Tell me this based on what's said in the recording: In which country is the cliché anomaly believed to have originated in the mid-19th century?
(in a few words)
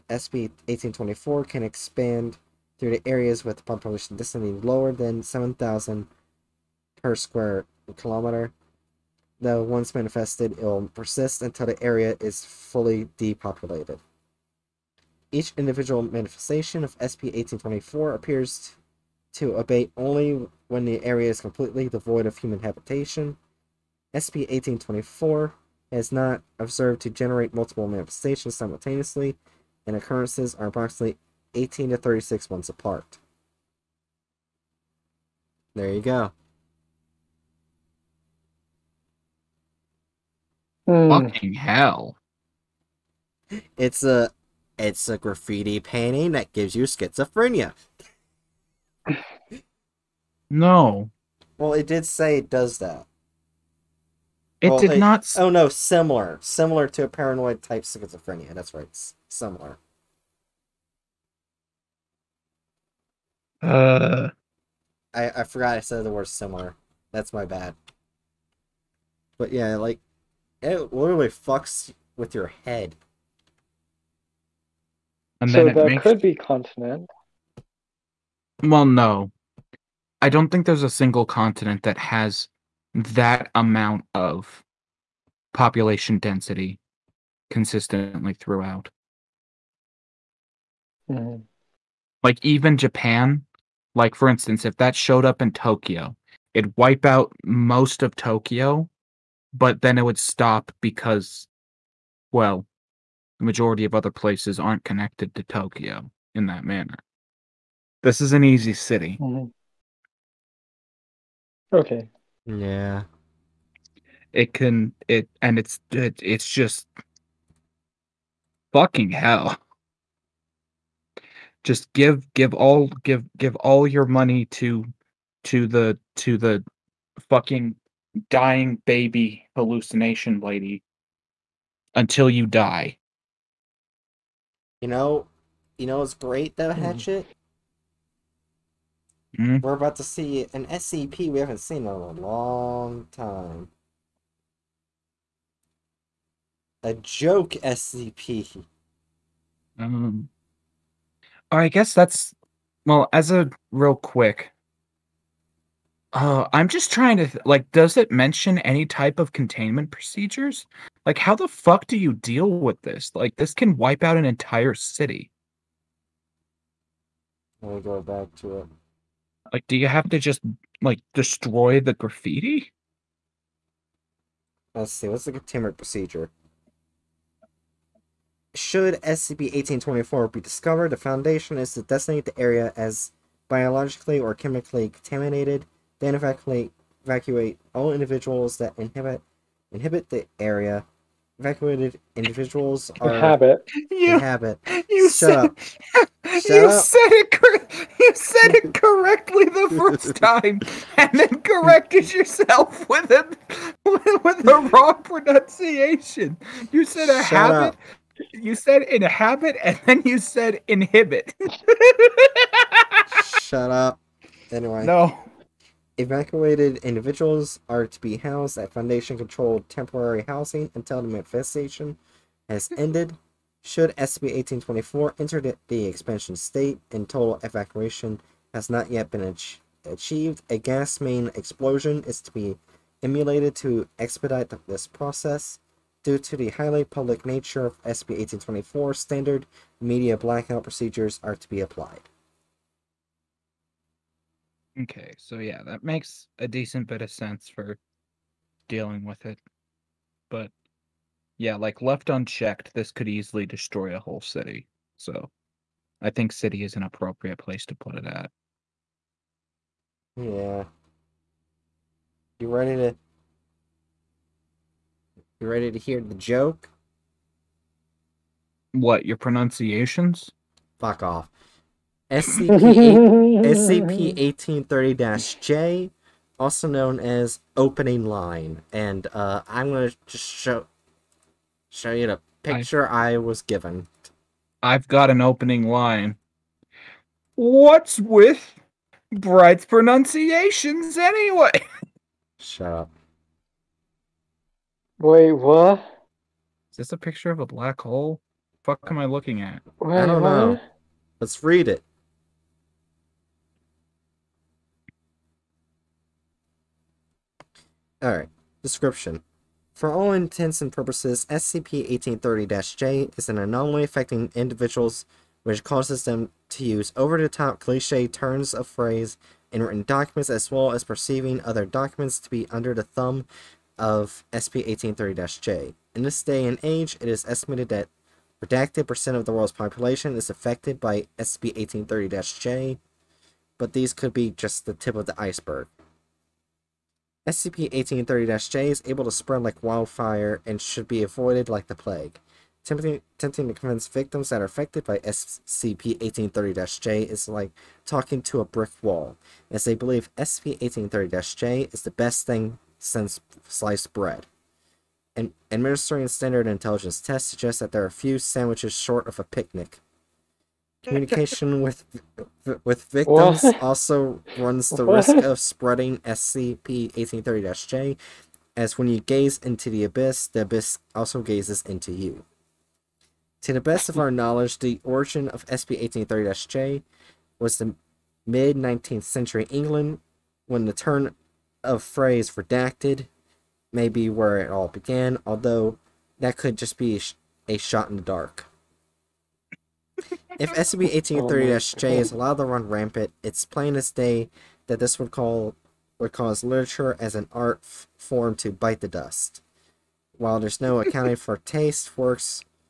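England.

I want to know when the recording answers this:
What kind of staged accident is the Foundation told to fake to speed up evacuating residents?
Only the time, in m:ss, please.
3:50.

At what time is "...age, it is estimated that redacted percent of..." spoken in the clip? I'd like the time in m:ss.
5:26.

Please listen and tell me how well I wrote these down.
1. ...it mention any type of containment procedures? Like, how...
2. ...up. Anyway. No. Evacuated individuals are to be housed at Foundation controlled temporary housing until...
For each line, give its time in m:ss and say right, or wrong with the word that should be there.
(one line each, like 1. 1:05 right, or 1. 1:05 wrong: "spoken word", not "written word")
1. 2:37 right
2. 3:33 right.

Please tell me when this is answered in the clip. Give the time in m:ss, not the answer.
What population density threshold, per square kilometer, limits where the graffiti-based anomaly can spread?
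0:05.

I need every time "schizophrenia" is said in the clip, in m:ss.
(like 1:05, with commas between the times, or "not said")
0:46, 0:57.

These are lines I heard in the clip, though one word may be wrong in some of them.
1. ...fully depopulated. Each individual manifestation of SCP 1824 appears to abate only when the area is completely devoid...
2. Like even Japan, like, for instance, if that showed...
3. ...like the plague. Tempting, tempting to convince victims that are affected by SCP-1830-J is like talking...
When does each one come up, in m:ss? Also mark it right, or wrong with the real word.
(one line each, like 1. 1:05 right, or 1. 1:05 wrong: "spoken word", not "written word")
1. 0:12 right
2. 1:32 right
3. 5:41 right.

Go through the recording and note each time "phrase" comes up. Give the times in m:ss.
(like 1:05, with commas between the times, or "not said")
5:18, 6:21.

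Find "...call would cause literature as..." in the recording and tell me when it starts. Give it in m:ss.
6:35.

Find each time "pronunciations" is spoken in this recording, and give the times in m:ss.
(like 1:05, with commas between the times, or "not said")
3:25, 4:29, 4:49.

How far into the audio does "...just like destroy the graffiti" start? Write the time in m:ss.
2:50.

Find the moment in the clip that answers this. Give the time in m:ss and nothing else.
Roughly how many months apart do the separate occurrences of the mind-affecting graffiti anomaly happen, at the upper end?
0:31.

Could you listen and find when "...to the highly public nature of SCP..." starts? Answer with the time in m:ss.
3:56.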